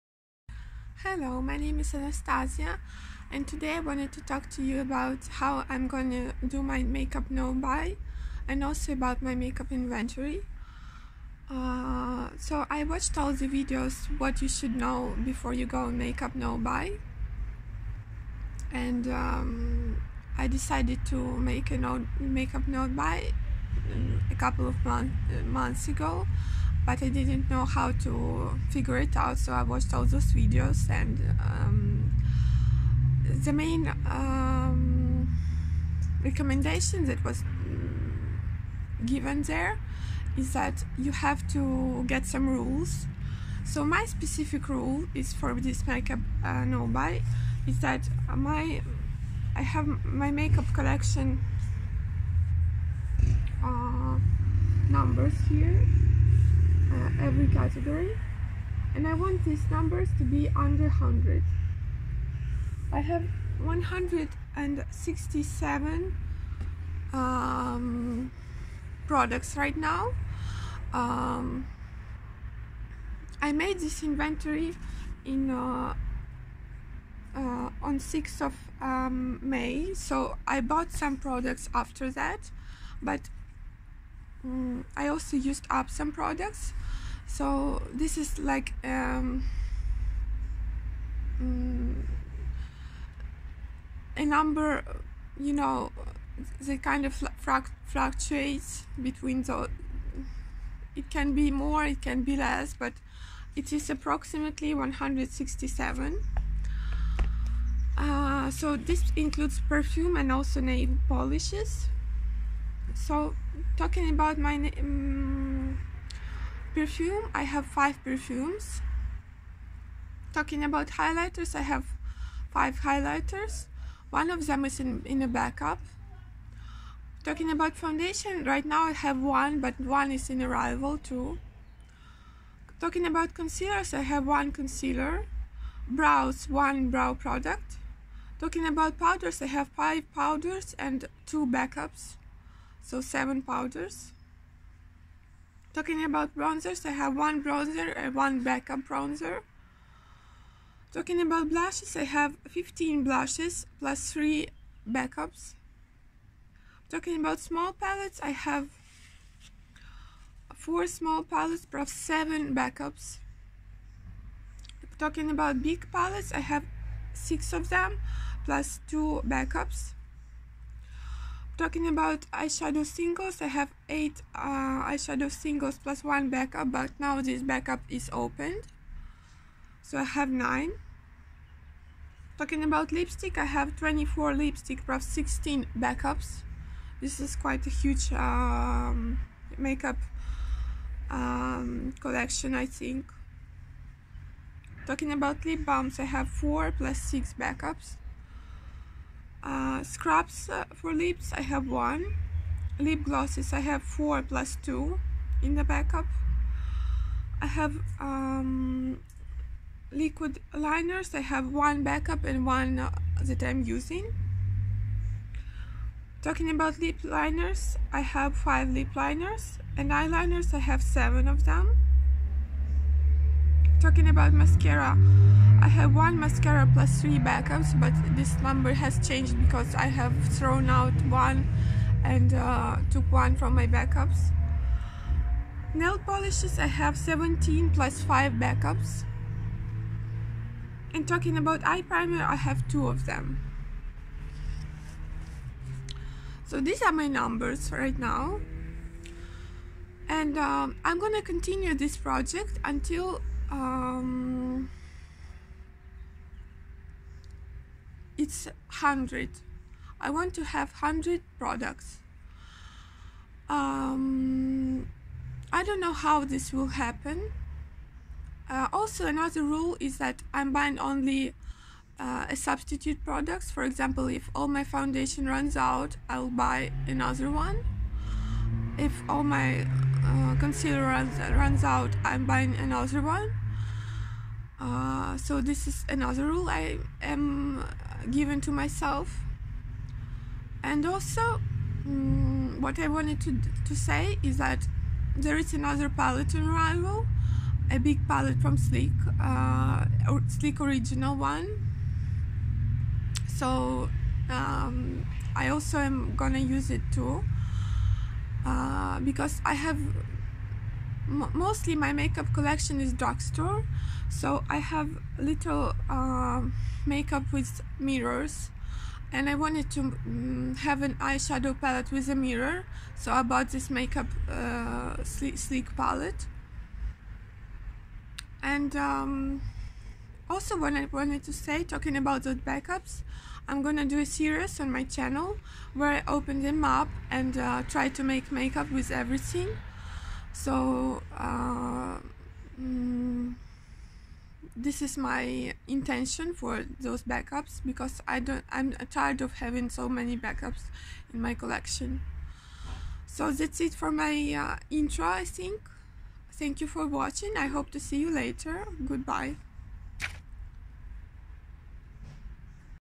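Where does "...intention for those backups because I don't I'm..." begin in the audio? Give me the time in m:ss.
5:45.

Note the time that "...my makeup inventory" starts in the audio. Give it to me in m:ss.
0:09.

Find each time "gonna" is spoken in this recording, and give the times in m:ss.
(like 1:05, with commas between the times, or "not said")
0:05, 4:10, 5:06, 5:33.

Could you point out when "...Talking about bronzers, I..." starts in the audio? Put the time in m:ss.
2:25.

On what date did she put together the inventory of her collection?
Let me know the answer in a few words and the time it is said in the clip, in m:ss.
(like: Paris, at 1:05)
6th of May, at 1:17.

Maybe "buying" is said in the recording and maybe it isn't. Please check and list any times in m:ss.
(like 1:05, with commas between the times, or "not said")
4:30, 4:42.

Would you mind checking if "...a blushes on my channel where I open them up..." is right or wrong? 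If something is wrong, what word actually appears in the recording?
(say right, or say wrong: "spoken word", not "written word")
wrong: "series", not "blushes".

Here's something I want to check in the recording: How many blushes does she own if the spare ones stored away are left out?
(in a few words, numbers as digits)
15.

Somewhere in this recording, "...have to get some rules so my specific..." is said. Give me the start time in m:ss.
0:41.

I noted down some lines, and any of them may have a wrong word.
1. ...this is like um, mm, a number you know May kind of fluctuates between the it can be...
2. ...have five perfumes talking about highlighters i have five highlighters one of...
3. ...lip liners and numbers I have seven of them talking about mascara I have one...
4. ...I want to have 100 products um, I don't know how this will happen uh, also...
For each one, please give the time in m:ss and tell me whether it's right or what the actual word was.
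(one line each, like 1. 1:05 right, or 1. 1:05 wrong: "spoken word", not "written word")
1. 1:27 wrong: "The", not "May"
2. 1:57 right
3. 3:38 wrong: "eyeliners", not "numbers"
4. 4:19 right.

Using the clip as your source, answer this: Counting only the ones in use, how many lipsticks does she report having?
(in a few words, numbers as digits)
24.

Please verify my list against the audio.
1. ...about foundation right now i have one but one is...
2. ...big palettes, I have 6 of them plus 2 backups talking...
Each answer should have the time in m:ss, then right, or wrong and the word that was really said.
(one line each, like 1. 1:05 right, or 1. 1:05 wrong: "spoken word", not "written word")
1. 2:07 right
2. 2:45 right.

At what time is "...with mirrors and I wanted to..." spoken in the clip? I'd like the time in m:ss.
5:17.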